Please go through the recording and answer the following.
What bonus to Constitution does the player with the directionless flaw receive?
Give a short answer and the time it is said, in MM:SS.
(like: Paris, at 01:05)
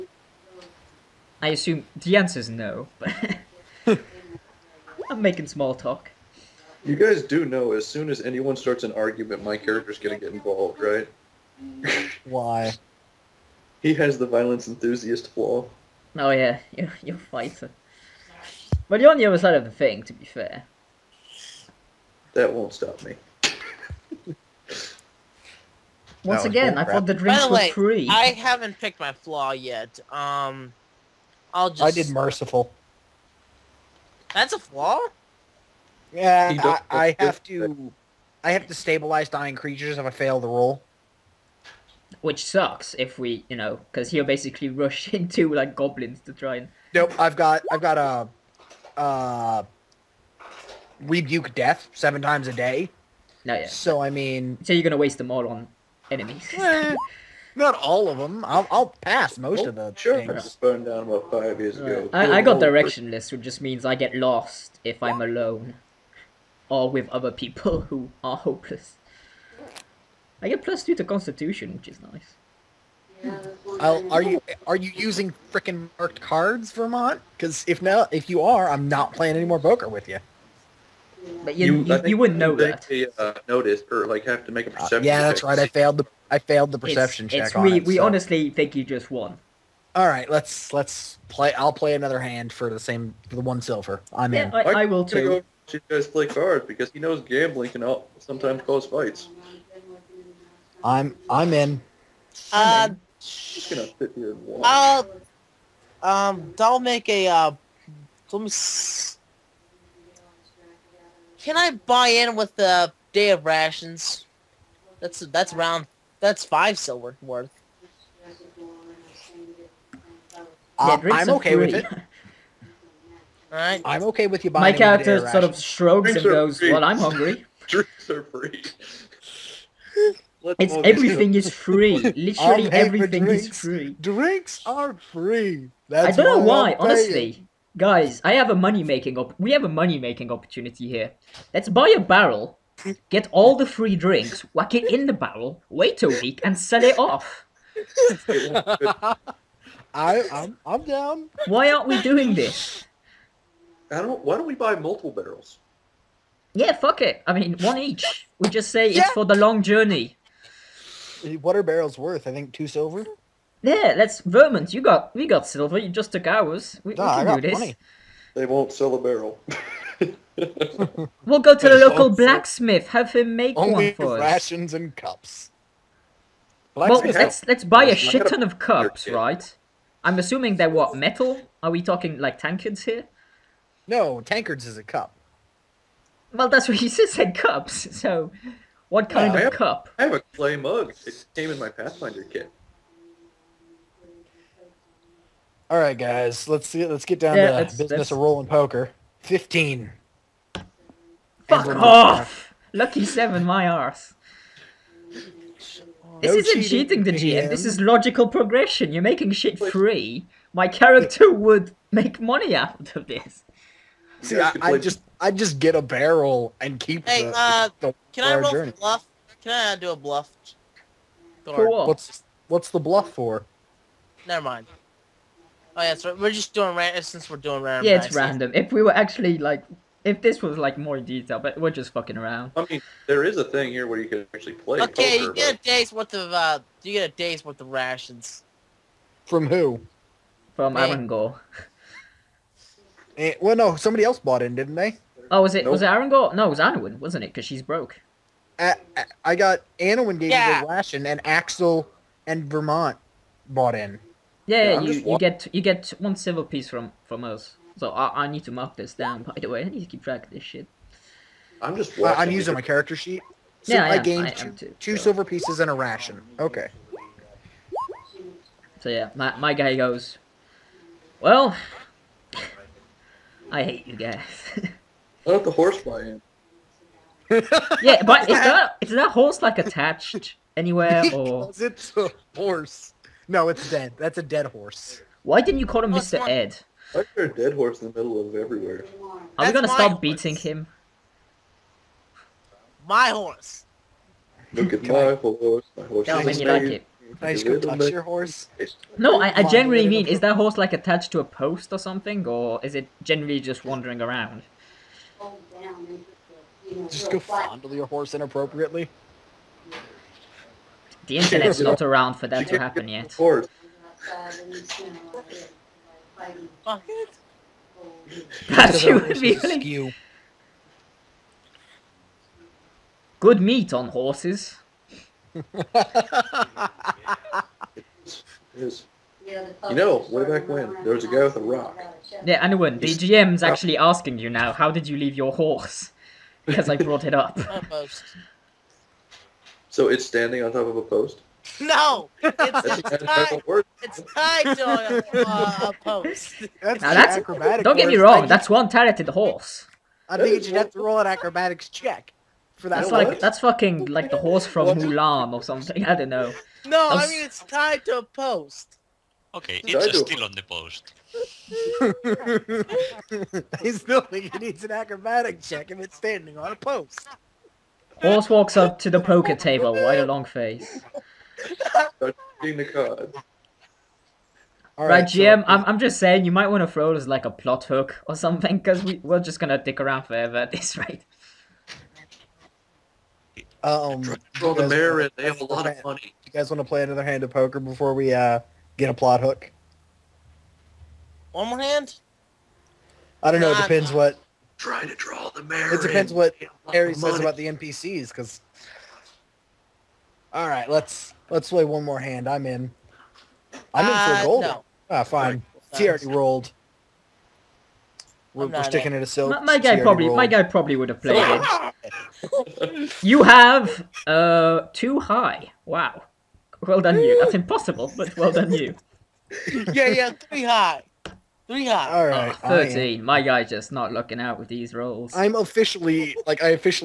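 Plus two, at 01:10.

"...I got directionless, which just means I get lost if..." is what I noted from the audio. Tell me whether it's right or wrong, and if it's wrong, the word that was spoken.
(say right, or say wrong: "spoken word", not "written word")
right.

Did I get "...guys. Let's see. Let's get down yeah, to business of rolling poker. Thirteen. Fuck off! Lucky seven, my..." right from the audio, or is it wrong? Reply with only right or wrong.
wrong.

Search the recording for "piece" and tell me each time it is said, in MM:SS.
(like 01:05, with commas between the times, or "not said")
04:16, 04:25.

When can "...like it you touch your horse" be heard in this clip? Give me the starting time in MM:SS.
04:56.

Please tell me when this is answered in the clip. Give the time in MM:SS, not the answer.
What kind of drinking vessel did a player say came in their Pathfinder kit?
03:10.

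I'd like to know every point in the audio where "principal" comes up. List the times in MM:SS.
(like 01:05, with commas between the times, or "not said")
not said.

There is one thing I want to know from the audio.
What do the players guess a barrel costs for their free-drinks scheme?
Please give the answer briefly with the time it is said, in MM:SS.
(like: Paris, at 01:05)
2 silver, at 02:42.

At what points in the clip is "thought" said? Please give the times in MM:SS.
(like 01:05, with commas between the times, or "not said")
00:26, 04:35.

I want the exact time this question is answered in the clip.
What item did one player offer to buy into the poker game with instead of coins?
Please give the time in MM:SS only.
01:53.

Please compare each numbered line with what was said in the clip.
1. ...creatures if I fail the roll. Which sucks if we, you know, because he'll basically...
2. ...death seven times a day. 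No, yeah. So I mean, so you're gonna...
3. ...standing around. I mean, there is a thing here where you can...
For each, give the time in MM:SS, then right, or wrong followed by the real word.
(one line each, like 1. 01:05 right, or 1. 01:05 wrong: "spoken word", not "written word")
1. 00:39 right
2. 00:51 right
3. 03:51 wrong: "fucking", not "standing".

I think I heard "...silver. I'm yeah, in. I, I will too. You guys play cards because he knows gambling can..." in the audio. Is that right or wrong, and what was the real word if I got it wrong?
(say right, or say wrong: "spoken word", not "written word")
right.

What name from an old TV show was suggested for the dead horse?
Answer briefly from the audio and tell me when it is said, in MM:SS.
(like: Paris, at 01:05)
Mr. Ed, at 04:45.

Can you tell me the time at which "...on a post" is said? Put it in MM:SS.
06:06.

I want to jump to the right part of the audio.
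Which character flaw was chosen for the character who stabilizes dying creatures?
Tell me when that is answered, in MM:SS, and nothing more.
00:32.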